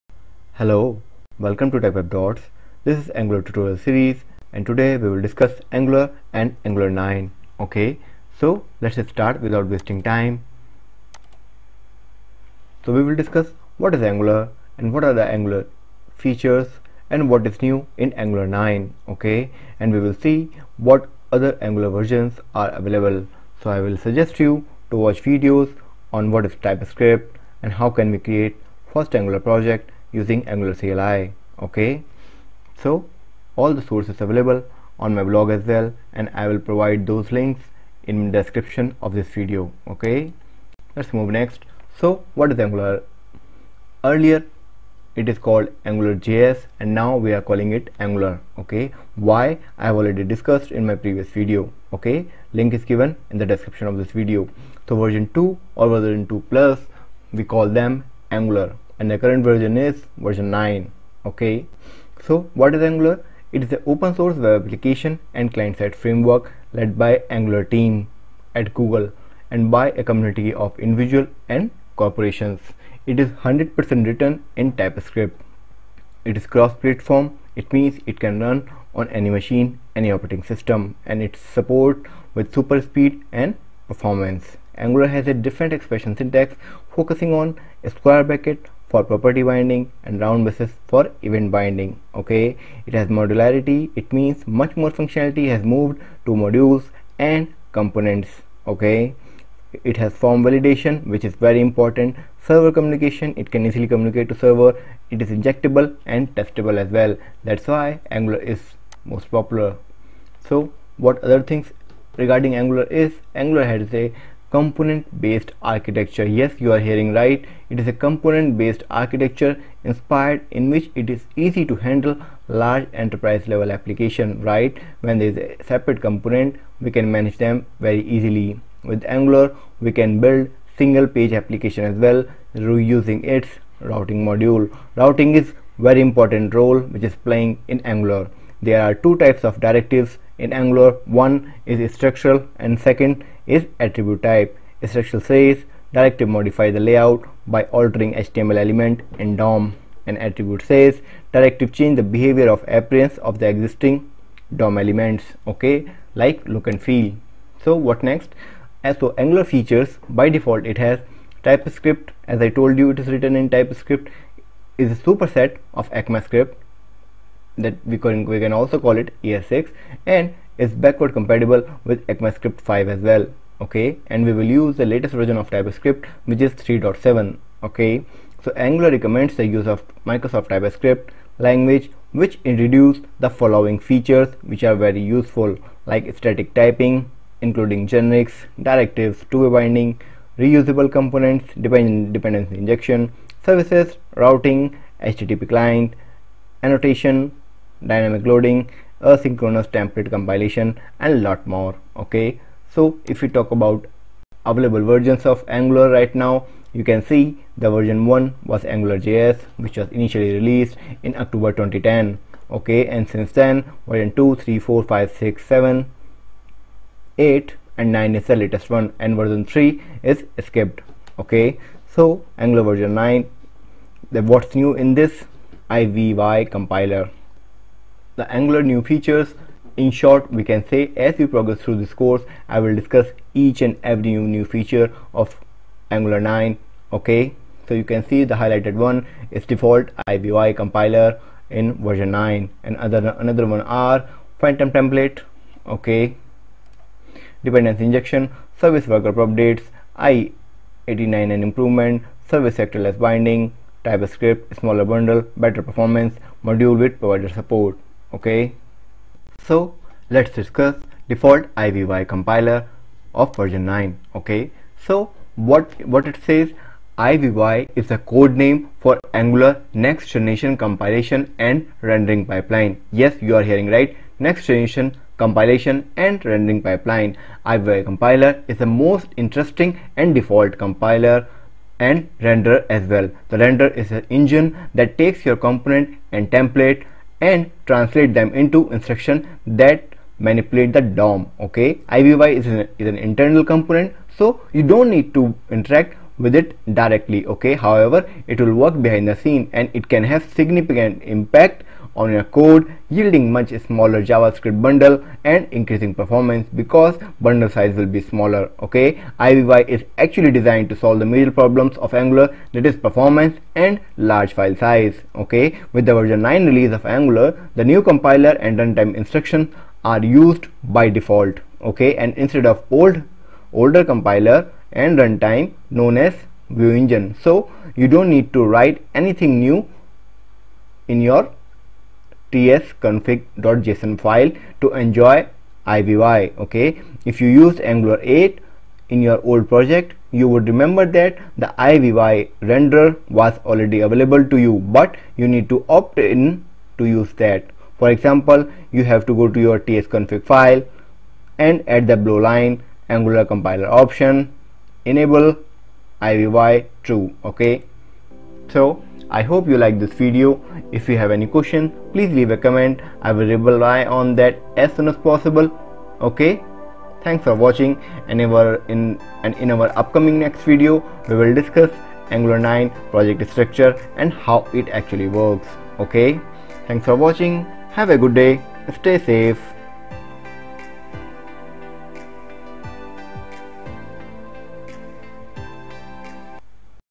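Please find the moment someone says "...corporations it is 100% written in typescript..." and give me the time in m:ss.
1:12.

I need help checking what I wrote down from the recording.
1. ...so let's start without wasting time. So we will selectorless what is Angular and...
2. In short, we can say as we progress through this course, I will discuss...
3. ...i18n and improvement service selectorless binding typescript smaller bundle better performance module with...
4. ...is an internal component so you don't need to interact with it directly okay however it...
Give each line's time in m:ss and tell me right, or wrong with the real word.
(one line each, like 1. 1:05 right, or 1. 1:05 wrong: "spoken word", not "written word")
1. 0:08 wrong: "discuss", not "selectorless"
2. 3:49 right
3. 4:10 right
4. 4:52 right.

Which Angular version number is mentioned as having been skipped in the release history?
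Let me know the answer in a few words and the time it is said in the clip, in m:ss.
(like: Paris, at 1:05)
version 3, at 3:39.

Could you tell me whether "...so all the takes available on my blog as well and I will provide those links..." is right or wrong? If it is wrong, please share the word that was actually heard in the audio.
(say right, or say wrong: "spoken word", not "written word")
wrong: "sources", not "takes".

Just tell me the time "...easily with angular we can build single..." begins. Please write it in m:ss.
2:08.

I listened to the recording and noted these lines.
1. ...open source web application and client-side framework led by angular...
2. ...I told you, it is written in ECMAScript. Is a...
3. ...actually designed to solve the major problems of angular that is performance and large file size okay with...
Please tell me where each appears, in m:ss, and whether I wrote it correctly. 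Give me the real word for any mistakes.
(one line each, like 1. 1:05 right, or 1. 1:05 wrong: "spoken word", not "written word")
1. 1:03 right
2. 2:42 wrong: "TypeScript", not "ECMAScript"
3. 5:09 right.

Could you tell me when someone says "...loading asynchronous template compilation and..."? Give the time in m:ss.
3:18.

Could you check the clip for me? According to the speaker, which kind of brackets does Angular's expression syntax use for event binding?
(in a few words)
round braces.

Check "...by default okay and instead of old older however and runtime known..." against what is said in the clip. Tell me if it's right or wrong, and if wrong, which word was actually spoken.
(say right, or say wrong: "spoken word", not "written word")
wrong: "compiler", not "however".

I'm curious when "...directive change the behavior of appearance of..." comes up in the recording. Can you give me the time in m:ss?
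2:31.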